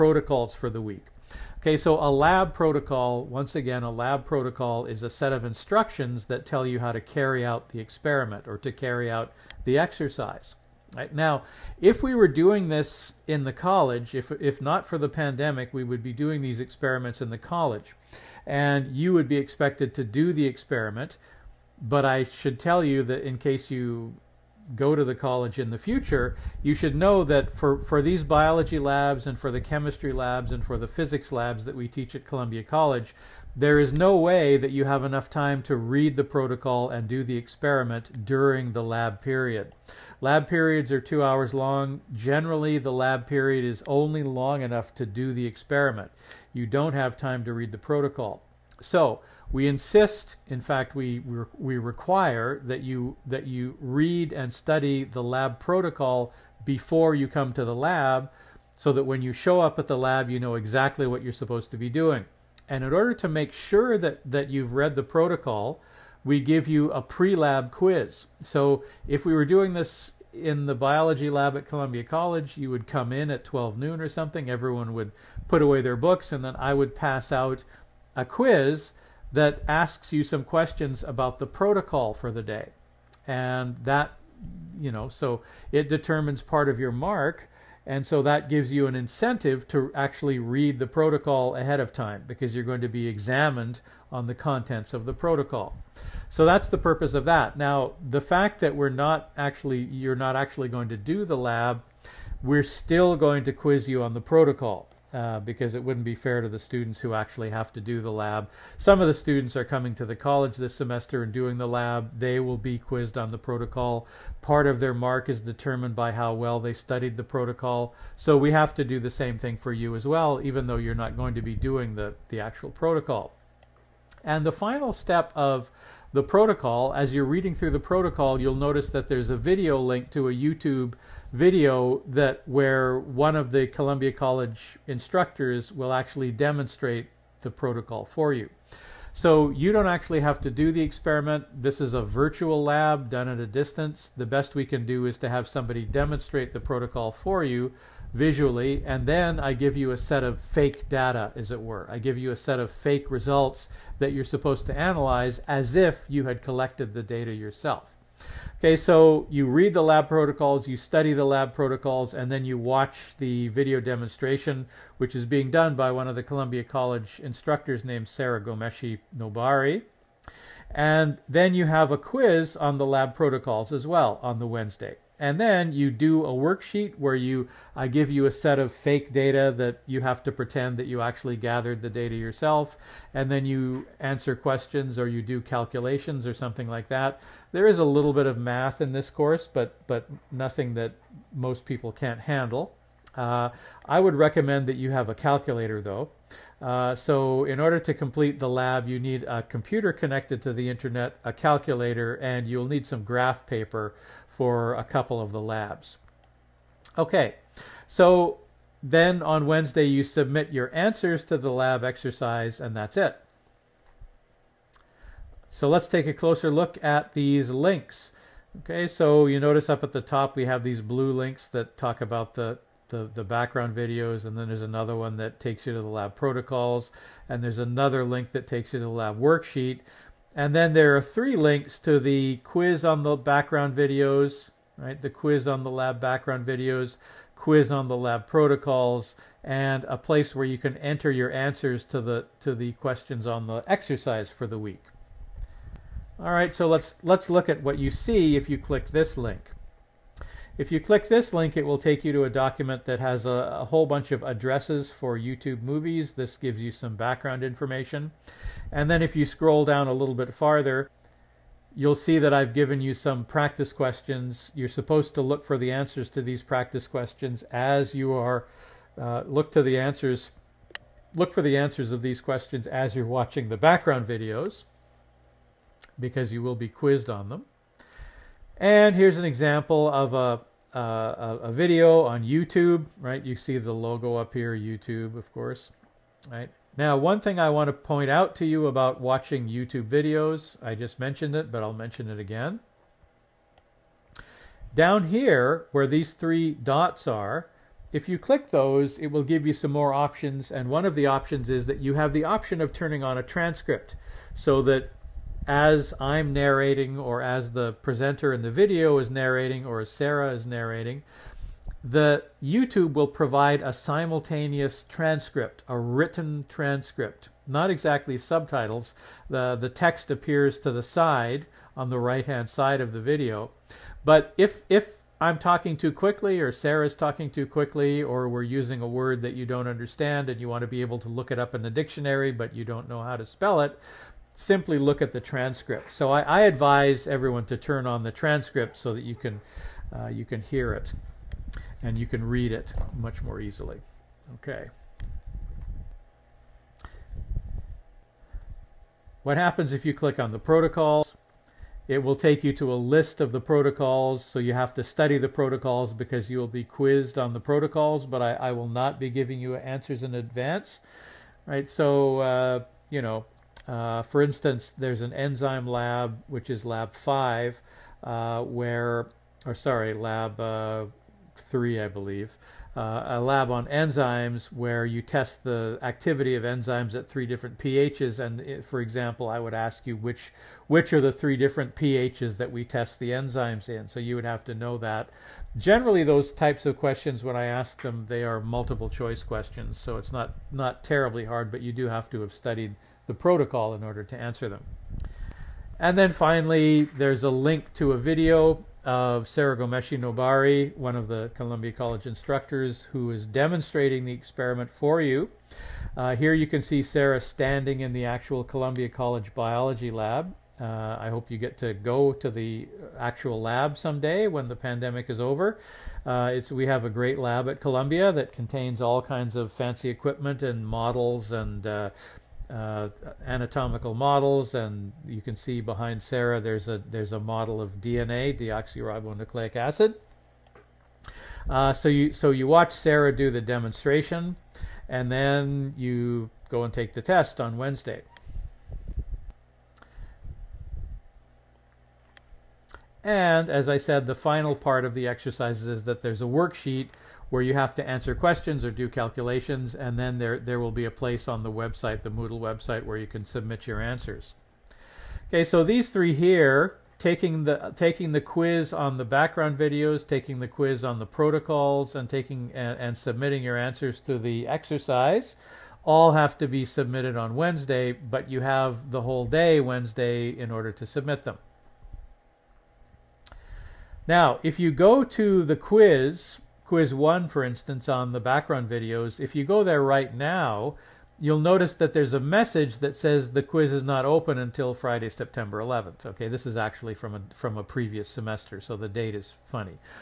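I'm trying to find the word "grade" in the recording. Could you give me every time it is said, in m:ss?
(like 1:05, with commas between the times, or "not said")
not said.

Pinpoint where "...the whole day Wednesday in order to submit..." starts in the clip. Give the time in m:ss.
7:48.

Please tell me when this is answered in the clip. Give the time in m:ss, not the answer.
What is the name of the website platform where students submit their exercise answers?
7:32.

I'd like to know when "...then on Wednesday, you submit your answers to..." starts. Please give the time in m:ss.
3:28.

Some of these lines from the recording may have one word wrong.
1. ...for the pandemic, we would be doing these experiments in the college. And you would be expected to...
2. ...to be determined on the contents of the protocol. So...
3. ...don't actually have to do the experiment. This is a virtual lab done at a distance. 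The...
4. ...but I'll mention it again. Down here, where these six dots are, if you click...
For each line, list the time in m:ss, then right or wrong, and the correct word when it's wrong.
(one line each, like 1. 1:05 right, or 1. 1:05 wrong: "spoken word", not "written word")
1. 0:14 right
2. 1:32 wrong: "examined", not "determined"
3. 2:19 right
4. 4:51 wrong: "three", not "six".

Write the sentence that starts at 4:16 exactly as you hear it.
This gives you some background information.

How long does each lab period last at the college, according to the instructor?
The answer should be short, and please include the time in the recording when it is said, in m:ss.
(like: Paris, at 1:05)
2 hours, at 0:40.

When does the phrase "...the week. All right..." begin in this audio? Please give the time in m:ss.
4:04.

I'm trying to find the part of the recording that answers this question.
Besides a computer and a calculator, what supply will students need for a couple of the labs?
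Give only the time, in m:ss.
3:23.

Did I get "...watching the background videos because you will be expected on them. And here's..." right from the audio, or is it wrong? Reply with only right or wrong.
wrong.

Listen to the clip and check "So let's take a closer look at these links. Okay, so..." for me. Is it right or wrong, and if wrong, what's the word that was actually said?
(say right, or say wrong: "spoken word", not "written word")
right.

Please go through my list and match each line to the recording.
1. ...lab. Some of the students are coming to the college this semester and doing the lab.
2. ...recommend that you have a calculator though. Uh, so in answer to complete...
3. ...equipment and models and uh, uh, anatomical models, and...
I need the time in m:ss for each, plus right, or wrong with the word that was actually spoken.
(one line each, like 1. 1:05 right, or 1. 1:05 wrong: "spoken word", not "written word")
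1. 1:48 right
2. 3:14 wrong: "order", not "answer"
3. 6:59 right.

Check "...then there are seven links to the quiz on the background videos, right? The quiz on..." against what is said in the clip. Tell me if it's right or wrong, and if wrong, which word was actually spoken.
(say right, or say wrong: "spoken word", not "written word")
wrong: "three", not "seven".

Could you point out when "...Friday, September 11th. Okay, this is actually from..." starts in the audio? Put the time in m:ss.
8:04.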